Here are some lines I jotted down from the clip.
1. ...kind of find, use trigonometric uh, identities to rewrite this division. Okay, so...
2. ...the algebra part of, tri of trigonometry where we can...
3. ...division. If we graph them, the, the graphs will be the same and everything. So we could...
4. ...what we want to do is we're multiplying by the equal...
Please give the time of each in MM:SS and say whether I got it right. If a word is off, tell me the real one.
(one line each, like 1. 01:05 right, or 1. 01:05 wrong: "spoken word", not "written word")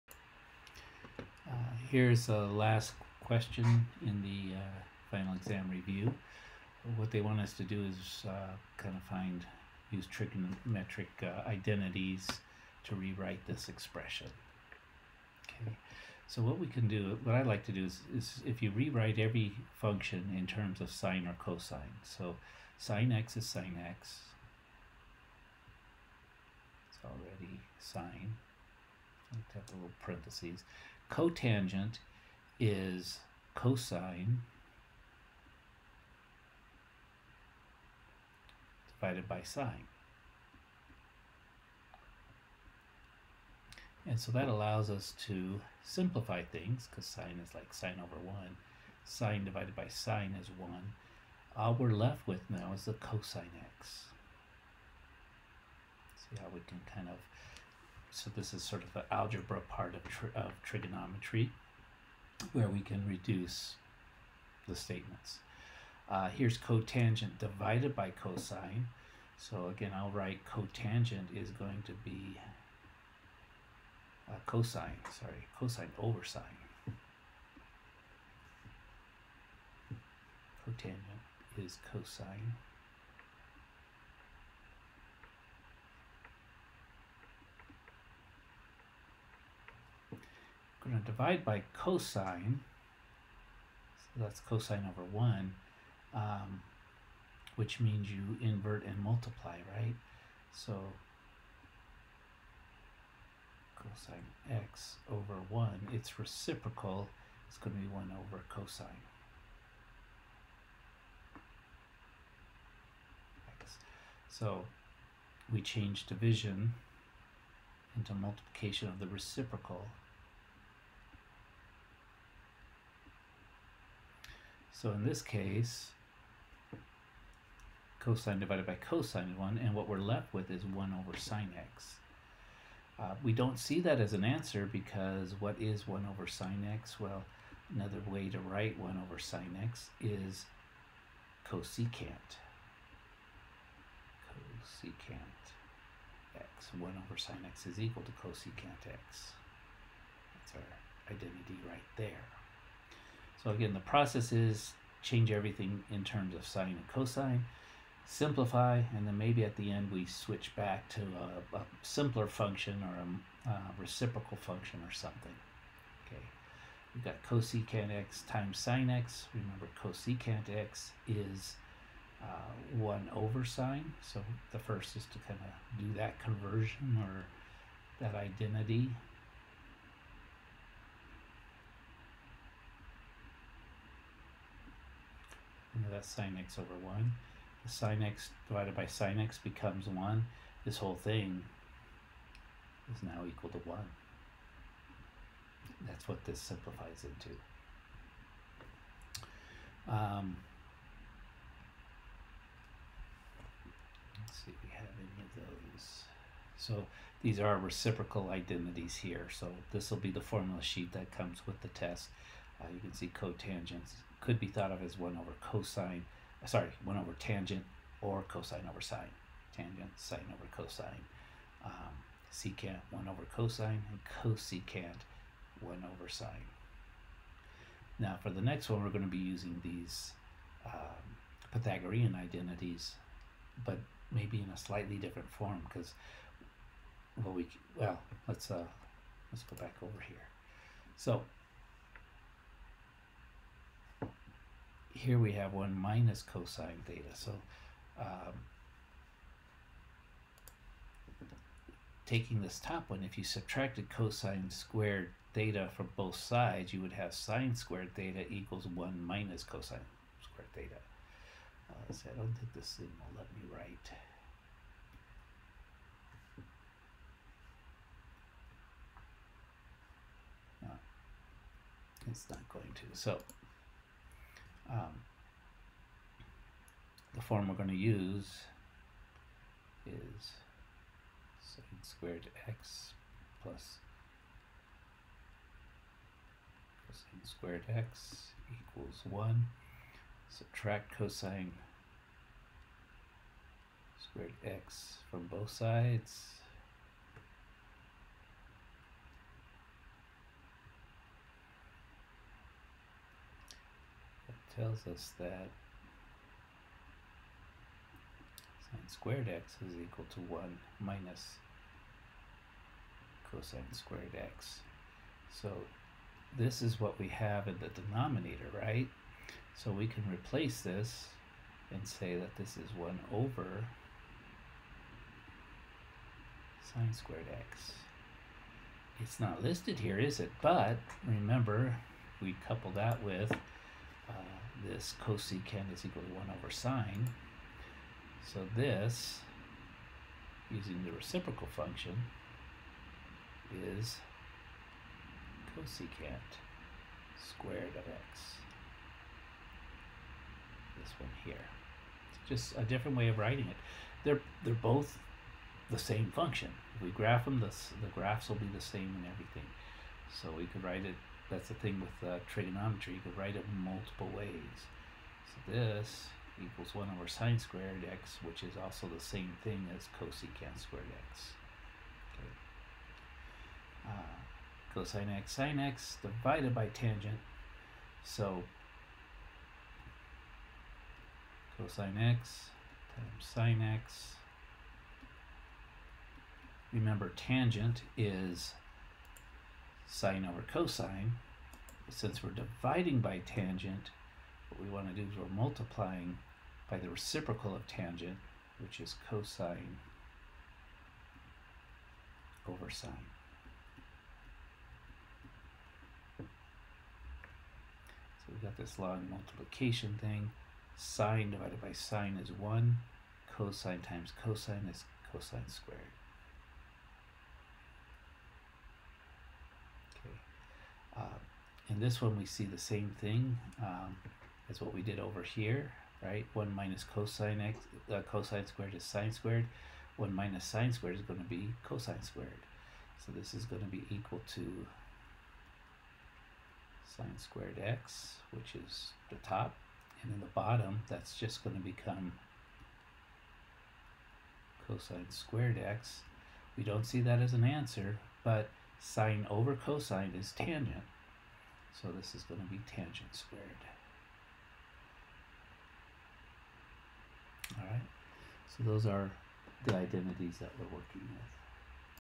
1. 00:08 wrong: "expression", not "division"
2. 00:58 right
3. 05:56 wrong: "function", not "division"
4. 06:34 wrong: "reciprocal", not "equal".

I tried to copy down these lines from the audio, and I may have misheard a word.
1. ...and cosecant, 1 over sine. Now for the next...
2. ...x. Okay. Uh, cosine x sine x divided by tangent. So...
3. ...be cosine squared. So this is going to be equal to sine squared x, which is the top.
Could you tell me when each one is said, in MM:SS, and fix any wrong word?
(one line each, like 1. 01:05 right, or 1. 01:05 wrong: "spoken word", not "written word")
1. 03:43 right
2. 06:11 right
3. 07:11 right.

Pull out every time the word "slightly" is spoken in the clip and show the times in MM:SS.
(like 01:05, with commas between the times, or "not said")
03:54.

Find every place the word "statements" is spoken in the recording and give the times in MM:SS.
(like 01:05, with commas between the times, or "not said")
01:04.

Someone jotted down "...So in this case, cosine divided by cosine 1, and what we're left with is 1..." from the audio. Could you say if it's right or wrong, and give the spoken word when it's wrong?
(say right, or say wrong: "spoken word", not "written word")
right.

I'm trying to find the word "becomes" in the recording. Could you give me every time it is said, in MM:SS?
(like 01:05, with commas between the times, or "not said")
03:09, 07:21.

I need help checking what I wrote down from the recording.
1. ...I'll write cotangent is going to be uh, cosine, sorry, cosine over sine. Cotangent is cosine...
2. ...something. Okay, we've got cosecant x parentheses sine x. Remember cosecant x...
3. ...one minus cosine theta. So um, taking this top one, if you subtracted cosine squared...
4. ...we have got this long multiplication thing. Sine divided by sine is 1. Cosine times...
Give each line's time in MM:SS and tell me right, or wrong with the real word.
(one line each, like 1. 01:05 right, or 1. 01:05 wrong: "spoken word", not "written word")
1. 01:09 right
2. 02:44 wrong: "times", not "parentheses"
3. 04:05 right
4. 06:48 right.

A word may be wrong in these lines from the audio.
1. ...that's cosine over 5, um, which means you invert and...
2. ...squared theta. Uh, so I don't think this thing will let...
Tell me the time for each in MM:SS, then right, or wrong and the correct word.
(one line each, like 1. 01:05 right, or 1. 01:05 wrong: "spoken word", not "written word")
1. 01:34 wrong: "1", not "5"
2. 04:20 right.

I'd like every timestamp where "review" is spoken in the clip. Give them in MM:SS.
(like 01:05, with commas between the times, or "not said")
00:05.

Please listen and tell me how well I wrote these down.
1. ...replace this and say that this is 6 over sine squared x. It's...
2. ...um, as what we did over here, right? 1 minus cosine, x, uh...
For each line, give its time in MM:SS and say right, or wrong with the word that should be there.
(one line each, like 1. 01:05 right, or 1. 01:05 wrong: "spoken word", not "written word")
1. 05:20 wrong: "1", not "6"
2. 07:03 right.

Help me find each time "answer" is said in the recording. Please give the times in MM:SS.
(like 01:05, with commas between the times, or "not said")
02:14, 07:27.